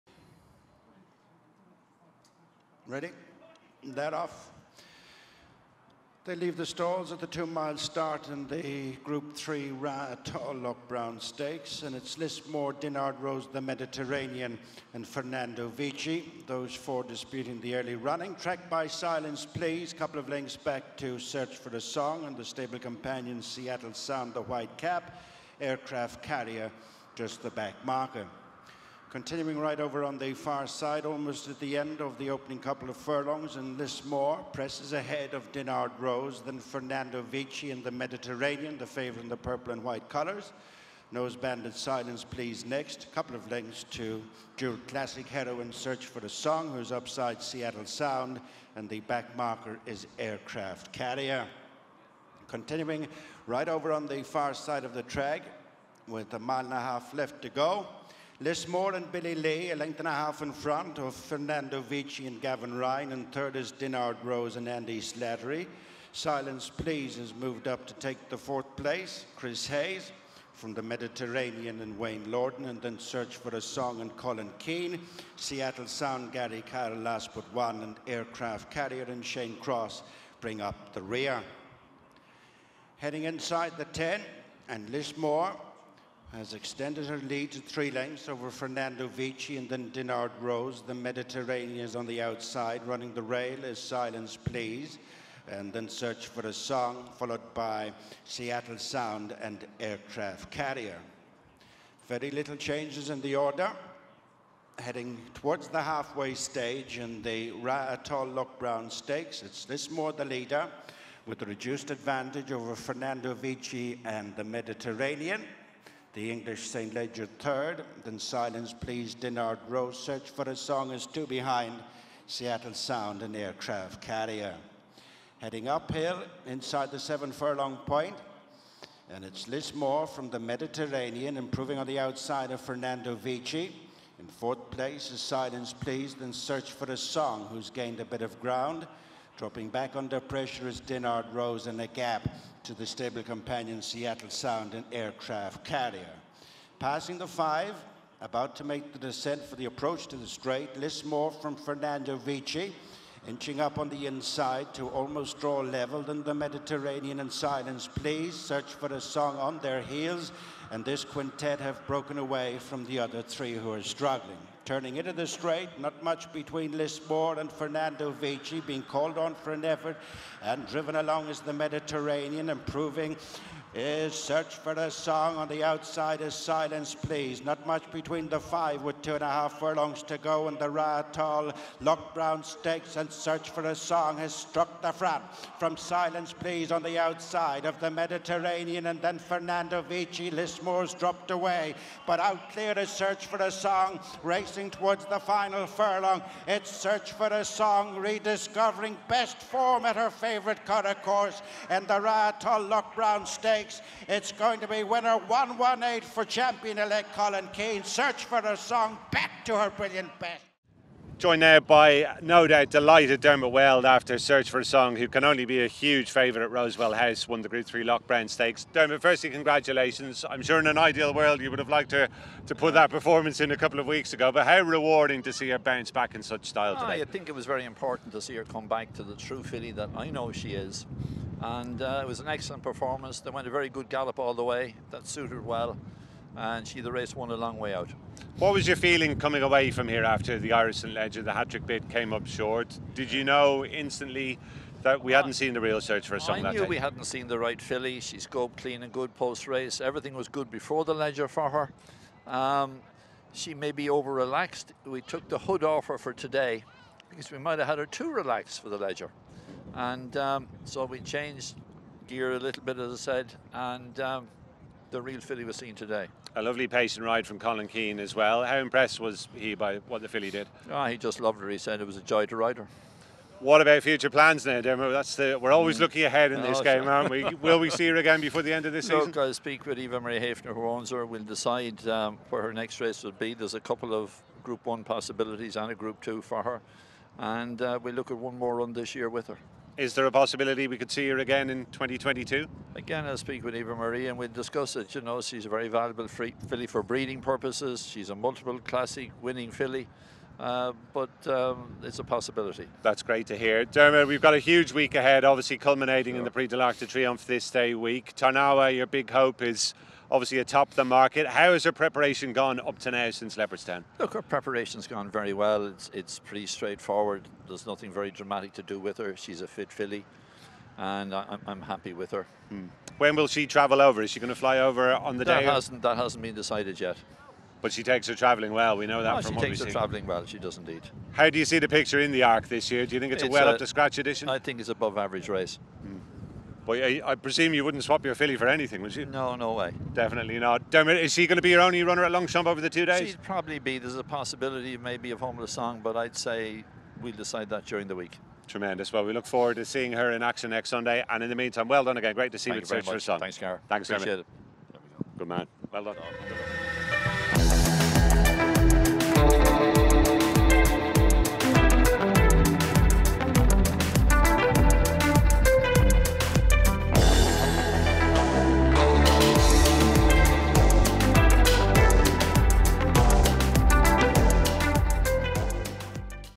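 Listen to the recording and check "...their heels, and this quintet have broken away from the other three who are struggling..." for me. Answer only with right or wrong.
right.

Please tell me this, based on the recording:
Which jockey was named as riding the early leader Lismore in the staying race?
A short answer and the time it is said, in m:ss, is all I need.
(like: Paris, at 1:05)
Billy Lee, at 0:59.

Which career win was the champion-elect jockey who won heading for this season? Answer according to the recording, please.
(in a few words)
118.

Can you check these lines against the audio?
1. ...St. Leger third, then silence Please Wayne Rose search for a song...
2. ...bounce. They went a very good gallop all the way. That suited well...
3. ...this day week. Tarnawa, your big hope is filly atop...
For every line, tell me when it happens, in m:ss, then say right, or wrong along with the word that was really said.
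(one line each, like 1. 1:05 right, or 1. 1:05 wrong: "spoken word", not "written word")
1. 1:56 wrong: "Dinard", not "Wayne"
2. 3:52 wrong: "performance", not "bounce"
3. 5:07 wrong: "obviously", not "filly".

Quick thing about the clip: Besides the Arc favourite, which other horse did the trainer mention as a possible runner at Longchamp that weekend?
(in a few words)
Homeless Song.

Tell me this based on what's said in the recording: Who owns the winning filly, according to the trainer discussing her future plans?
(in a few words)
Eva Marie Haefner.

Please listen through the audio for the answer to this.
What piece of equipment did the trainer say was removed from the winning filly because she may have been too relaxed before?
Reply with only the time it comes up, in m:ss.
4:15.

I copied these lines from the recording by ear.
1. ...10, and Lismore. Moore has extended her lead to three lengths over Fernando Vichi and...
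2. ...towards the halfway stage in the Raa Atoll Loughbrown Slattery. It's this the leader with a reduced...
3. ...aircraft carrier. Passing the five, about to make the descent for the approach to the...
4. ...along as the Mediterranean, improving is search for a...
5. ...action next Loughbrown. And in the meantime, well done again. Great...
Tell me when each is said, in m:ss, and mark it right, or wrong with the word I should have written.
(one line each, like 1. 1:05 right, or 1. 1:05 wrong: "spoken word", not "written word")
1. 1:23 right
2. 1:45 wrong: "Stakes", not "Slattery"
3. 2:24 right
4. 2:50 right
5. 5:50 wrong: "Sunday", not "Loughbrown".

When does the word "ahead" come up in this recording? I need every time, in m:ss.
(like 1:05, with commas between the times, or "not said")
0:34, 4:36, 5:04.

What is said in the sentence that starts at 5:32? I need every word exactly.
Do you think it's, it's a well a, up to scratch edition?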